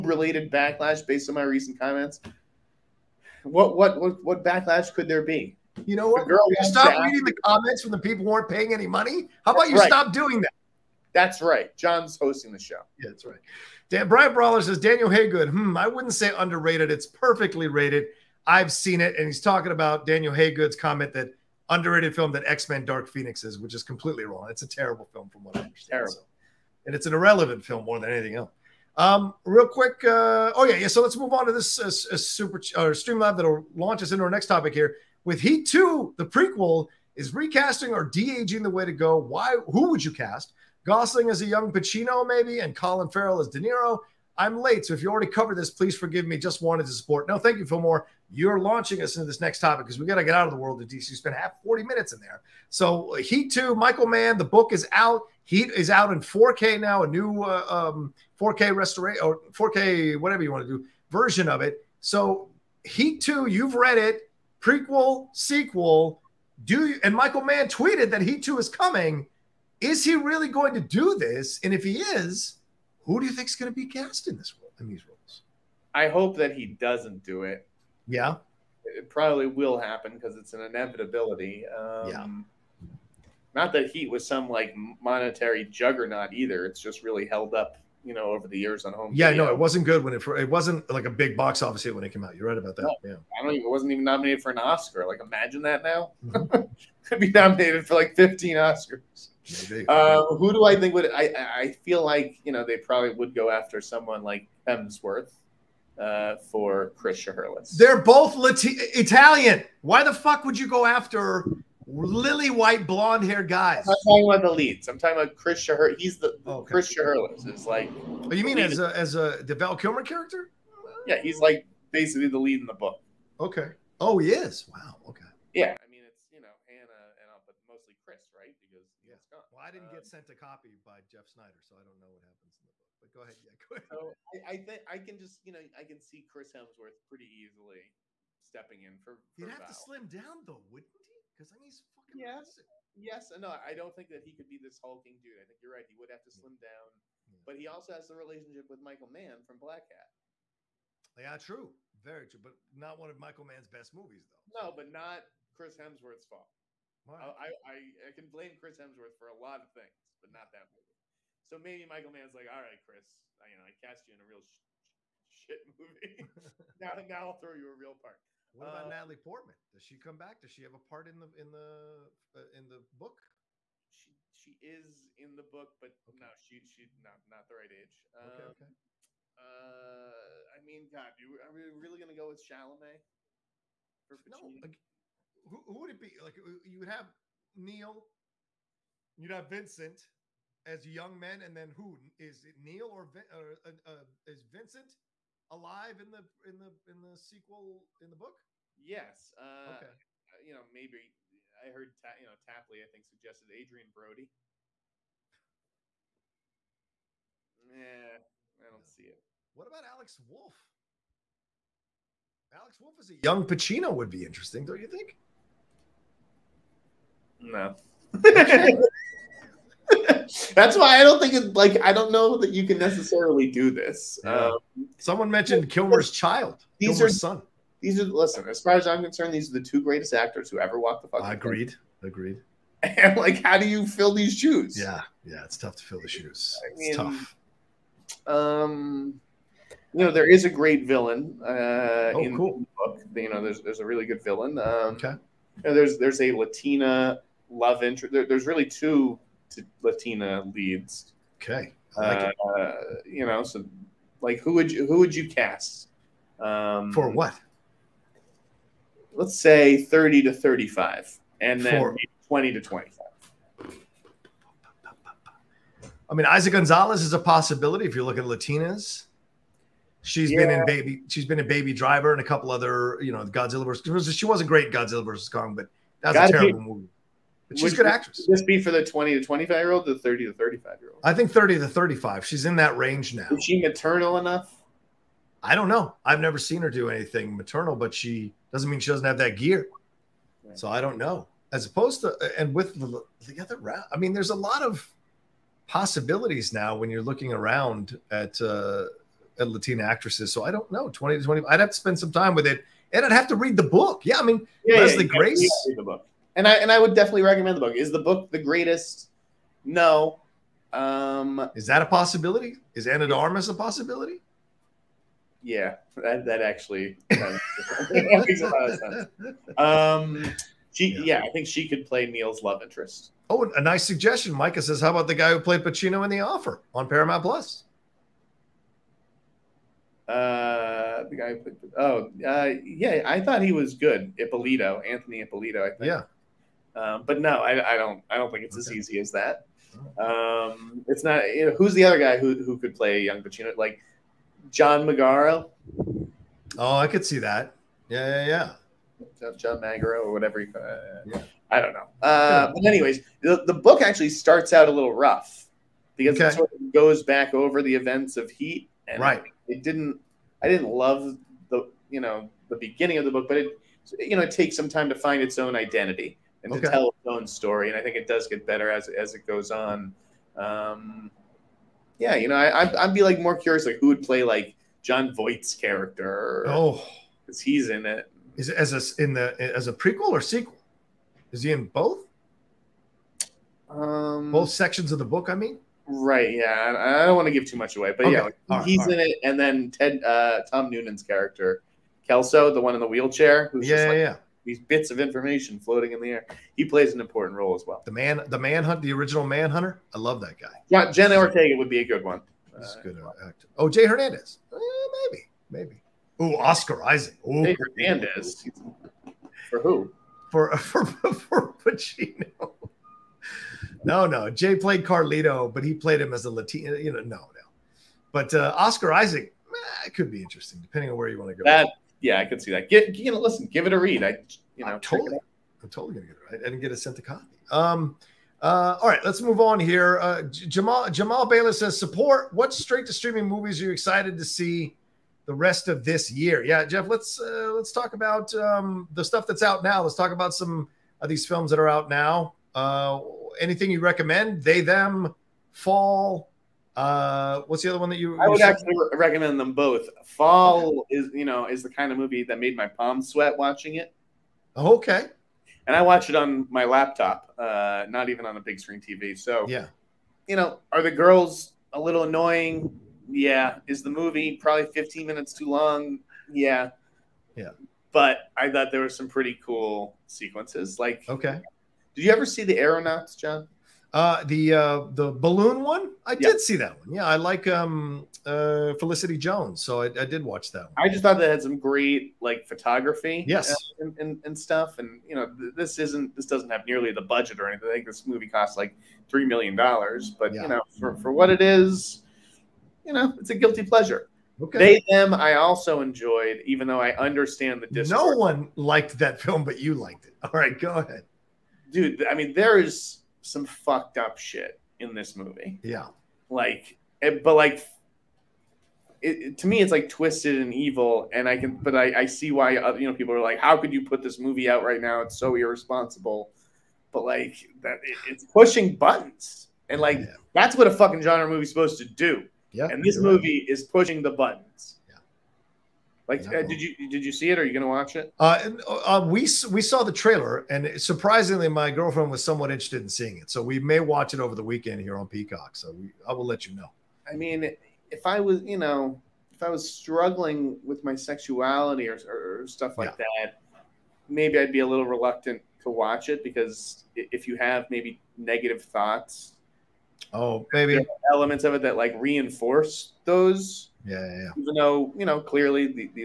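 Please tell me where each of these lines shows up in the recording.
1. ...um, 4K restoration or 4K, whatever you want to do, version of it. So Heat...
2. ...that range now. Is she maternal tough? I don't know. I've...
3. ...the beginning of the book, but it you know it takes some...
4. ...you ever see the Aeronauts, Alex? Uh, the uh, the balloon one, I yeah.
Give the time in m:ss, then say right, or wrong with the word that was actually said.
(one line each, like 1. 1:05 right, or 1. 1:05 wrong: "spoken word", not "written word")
1. 0:57 right
2. 4:42 wrong: "enough", not "tough"
3. 6:02 right
4. 7:52 wrong: "John", not "Alex".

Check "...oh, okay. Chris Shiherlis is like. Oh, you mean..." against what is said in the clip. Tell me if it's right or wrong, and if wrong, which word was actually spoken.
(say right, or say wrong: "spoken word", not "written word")
right.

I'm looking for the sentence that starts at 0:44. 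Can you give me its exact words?
I'm late, so if you already covered this, please forgive me.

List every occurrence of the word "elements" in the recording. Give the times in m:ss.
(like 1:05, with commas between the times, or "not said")
9:11.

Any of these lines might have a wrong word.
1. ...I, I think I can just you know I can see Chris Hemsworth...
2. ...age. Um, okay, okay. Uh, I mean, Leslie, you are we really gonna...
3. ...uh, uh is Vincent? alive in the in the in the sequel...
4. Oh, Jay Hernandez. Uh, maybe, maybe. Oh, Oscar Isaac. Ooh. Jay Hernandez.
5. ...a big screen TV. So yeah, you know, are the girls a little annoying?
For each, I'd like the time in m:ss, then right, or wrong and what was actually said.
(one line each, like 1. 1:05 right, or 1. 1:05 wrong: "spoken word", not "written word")
1. 2:14 right
2. 2:57 wrong: "God", not "Leslie"
3. 3:13 right
4. 6:43 right
5. 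7:38 right.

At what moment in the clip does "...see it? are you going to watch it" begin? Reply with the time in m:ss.
8:47.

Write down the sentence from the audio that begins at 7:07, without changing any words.
Um, uh, all right, let's move on here.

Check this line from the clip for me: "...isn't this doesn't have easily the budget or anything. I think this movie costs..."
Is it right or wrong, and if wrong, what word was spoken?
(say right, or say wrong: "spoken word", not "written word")
wrong: "nearly", not "easily".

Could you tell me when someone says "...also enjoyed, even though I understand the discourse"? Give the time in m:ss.
8:15.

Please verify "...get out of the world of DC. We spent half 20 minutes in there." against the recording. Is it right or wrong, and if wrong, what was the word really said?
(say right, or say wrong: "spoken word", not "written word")
wrong: "40", not "20".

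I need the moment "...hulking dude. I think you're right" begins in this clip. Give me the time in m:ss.
2:24.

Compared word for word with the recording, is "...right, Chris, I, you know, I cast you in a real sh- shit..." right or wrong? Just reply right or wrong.
right.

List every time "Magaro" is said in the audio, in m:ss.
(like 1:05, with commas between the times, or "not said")
5:44, 5:49.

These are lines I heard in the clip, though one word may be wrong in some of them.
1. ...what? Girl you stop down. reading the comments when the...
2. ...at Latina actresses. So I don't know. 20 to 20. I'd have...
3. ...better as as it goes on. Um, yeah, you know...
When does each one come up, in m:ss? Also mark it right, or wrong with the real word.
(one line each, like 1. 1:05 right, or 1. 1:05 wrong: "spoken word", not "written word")
1. 0:06 right
2. 4:59 right
3. 6:08 right.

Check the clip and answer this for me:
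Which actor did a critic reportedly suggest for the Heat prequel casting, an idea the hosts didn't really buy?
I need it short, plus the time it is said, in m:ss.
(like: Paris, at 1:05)
Adrien Brody, at 3:23.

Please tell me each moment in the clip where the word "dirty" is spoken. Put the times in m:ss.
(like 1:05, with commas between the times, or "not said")
not said.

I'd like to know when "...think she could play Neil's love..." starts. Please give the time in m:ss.
5:21.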